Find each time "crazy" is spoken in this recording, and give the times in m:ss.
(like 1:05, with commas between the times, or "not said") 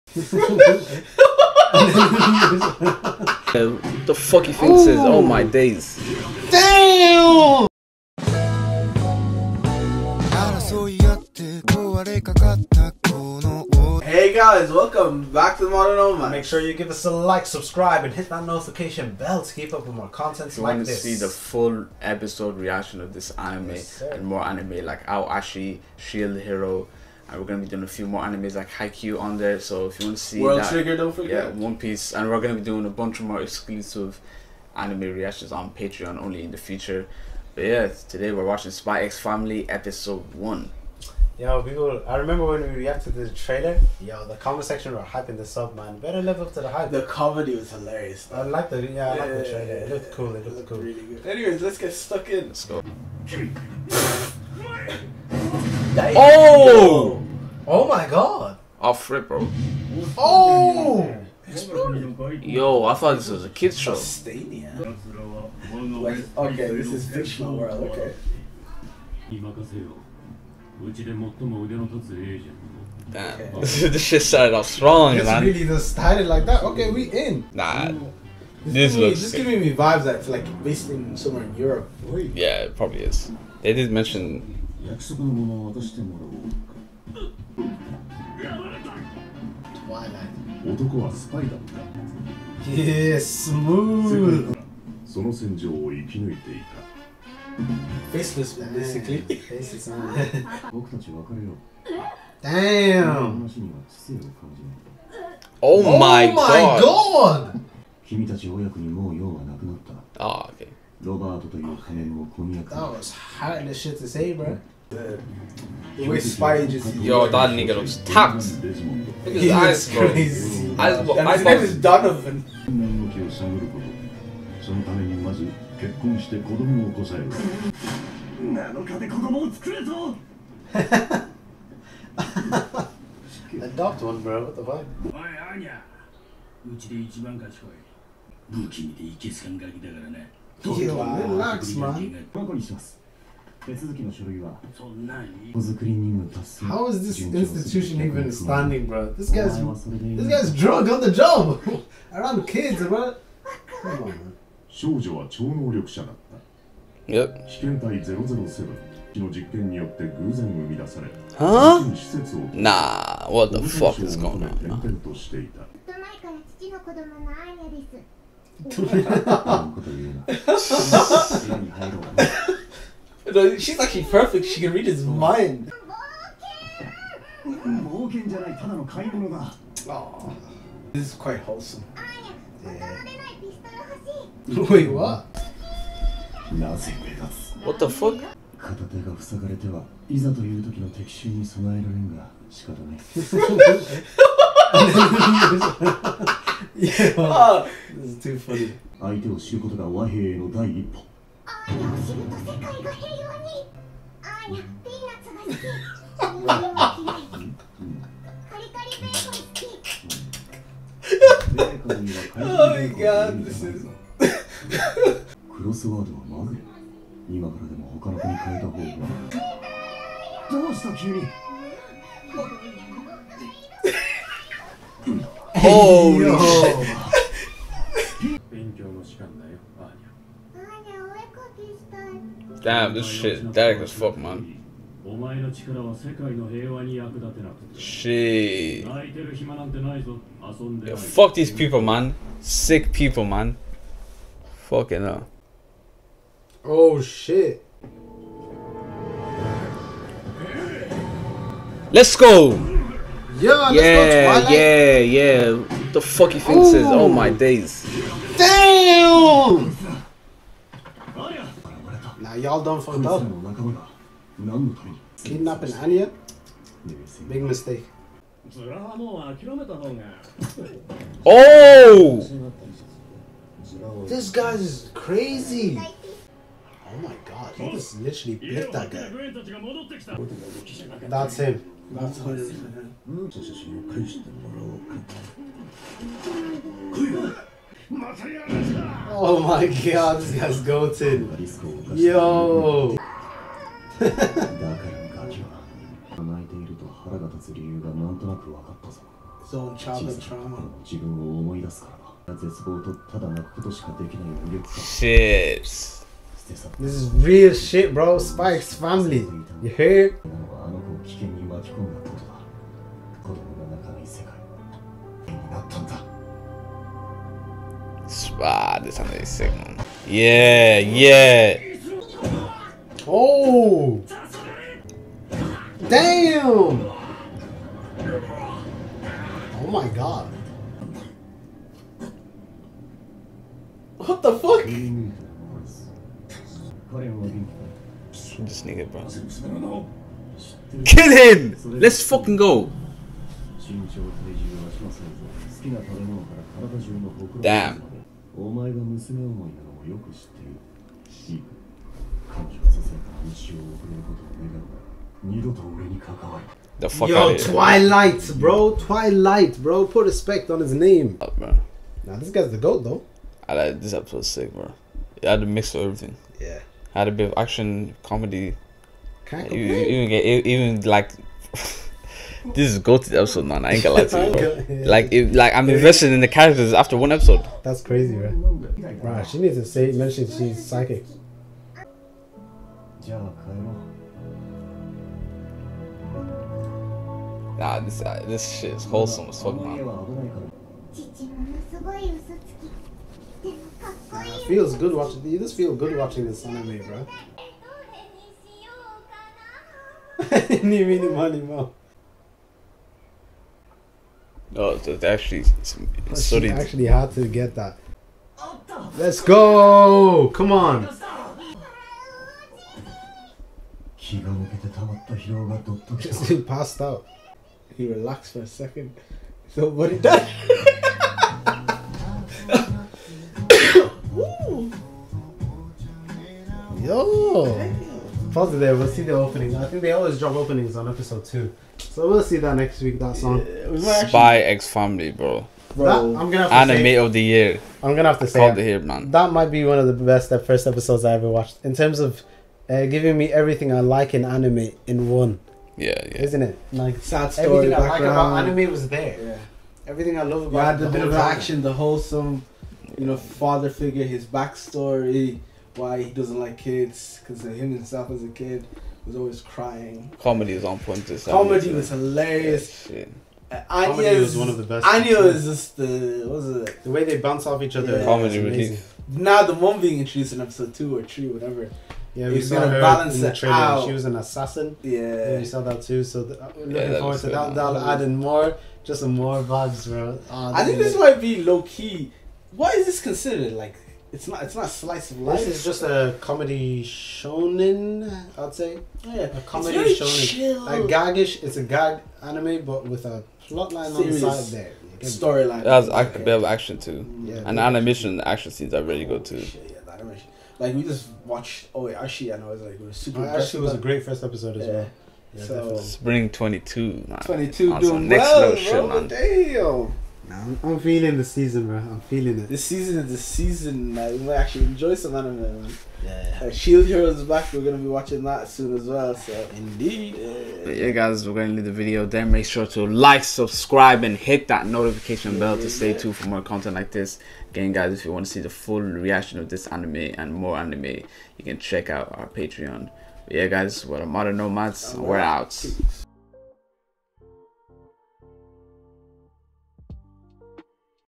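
4:34, 6:17.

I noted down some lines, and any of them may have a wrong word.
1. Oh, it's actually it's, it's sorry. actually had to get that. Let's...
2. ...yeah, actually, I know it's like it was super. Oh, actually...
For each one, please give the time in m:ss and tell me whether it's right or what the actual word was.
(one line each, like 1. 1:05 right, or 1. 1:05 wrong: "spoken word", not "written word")
1. 6:44 right
2. 8:21 right.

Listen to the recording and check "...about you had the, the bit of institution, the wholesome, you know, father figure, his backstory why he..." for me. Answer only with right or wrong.
wrong.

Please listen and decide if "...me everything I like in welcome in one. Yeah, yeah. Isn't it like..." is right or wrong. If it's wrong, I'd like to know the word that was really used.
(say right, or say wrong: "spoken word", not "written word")
wrong: "anime", not "welcome".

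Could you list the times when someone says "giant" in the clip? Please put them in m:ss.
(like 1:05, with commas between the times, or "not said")
not said.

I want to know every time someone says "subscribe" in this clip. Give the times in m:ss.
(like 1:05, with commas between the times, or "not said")
0:17, 8:43.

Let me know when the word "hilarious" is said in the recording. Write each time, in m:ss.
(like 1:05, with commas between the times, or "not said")
0:47, 7:41.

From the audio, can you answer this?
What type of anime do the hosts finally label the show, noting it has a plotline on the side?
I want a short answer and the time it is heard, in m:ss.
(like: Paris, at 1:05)
Gag anime, at 8:11.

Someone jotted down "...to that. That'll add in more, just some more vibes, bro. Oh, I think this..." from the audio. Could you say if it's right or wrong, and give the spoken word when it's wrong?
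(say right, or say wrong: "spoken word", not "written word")
right.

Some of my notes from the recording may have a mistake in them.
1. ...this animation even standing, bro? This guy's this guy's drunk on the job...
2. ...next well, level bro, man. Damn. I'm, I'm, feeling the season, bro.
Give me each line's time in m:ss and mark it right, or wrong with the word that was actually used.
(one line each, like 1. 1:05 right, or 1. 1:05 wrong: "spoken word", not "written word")
1. 2:27 wrong: "institution", not "animation"
2. 8:28 right.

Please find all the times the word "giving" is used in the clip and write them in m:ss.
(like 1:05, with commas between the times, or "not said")
1:19, 7:22.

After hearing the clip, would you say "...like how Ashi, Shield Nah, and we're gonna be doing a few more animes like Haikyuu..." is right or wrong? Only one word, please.
wrong.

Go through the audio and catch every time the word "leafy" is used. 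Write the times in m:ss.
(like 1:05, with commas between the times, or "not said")
not said.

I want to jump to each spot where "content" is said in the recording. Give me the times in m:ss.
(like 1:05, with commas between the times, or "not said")
0:20, 8:46.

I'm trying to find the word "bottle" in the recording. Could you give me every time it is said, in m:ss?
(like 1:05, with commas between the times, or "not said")
not said.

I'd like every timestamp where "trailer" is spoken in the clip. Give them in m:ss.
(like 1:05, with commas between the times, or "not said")
0:43, 0:49, 7:53.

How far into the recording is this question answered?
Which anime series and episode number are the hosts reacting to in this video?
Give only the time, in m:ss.
0:38.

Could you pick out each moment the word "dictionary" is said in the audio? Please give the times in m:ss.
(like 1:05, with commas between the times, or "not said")
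not said.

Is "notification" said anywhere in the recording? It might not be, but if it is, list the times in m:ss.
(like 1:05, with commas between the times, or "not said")
0:18, 8:44.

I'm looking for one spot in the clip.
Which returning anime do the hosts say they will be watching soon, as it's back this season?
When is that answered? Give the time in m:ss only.
8:36.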